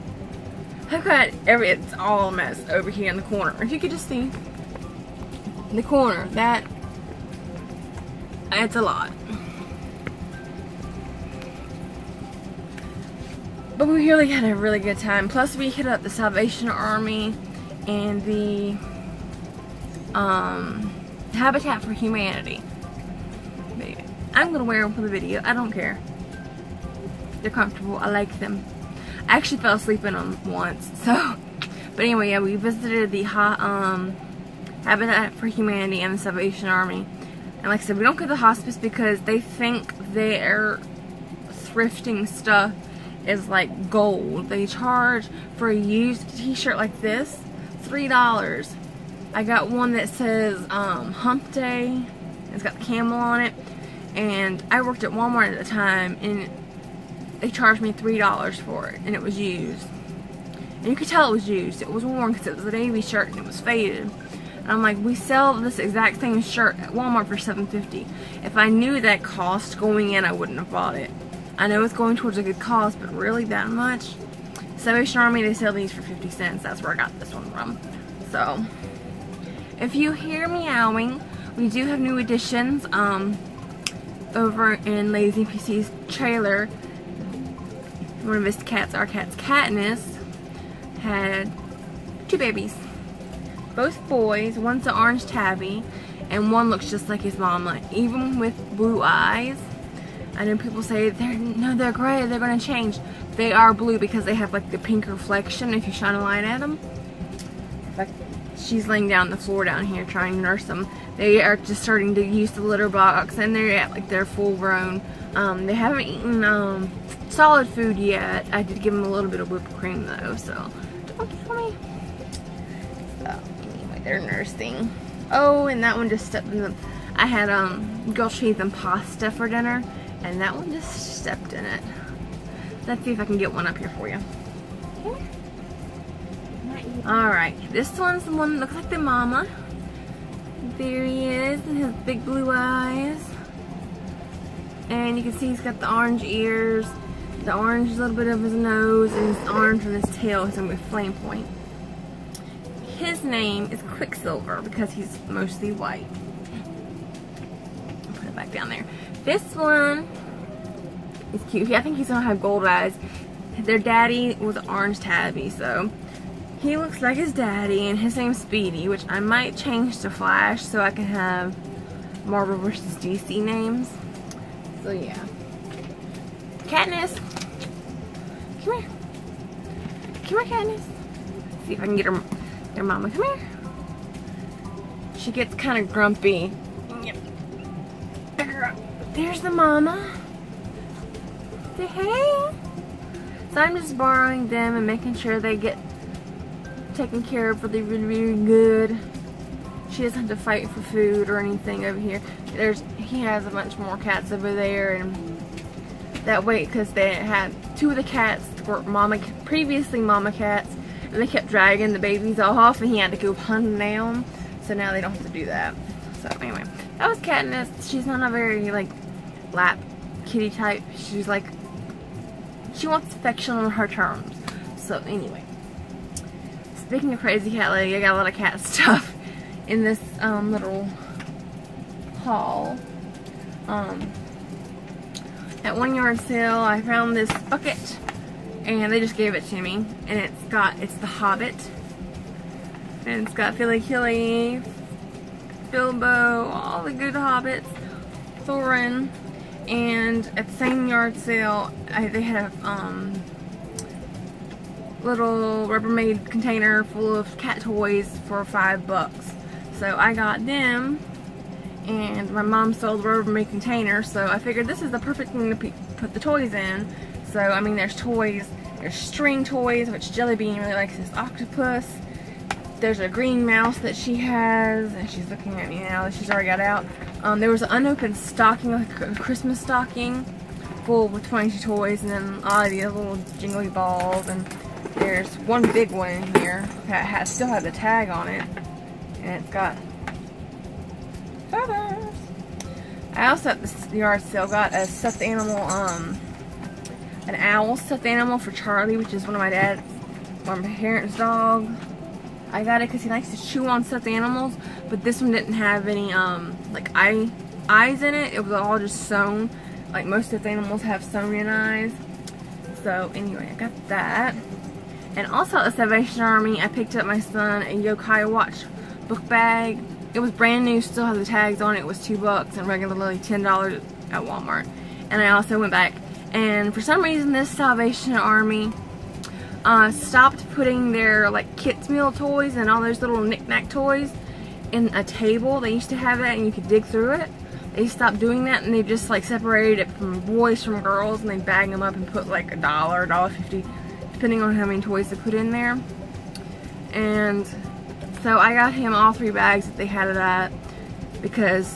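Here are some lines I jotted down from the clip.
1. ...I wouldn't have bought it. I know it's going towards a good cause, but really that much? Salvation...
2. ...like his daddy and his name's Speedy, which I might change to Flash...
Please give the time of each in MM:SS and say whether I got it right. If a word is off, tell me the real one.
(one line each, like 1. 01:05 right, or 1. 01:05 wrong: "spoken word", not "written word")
1. 01:10 right
2. 02:46 right.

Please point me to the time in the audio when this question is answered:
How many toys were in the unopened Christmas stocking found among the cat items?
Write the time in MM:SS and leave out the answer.
04:41.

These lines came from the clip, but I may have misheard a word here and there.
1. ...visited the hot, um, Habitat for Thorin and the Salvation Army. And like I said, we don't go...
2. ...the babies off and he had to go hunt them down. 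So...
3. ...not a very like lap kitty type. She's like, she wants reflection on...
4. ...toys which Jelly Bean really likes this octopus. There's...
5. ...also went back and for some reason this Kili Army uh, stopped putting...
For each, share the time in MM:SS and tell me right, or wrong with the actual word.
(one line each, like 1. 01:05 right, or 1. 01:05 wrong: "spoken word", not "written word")
1. 00:32 wrong: "Humanity", not "Thorin"
2. 03:31 right
3. 03:38 wrong: "affection", not "reflection"
4. 04:29 right
5. 05:25 wrong: "Salvation", not "Kili".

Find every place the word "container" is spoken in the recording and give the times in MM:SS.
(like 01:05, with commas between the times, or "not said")
04:16, 04:23.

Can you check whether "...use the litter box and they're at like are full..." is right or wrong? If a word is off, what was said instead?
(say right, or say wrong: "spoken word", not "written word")
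right.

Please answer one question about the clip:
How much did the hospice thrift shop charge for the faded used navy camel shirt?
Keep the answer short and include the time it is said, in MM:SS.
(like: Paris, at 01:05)
$3, at 00:47.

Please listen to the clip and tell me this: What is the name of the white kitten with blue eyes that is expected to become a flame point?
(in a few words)
Quicksilver.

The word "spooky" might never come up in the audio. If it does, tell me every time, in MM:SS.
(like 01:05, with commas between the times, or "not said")
not said.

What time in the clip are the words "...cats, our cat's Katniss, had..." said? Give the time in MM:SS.
01:28.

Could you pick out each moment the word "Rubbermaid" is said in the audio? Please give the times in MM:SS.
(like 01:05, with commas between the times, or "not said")
04:15, 04:23.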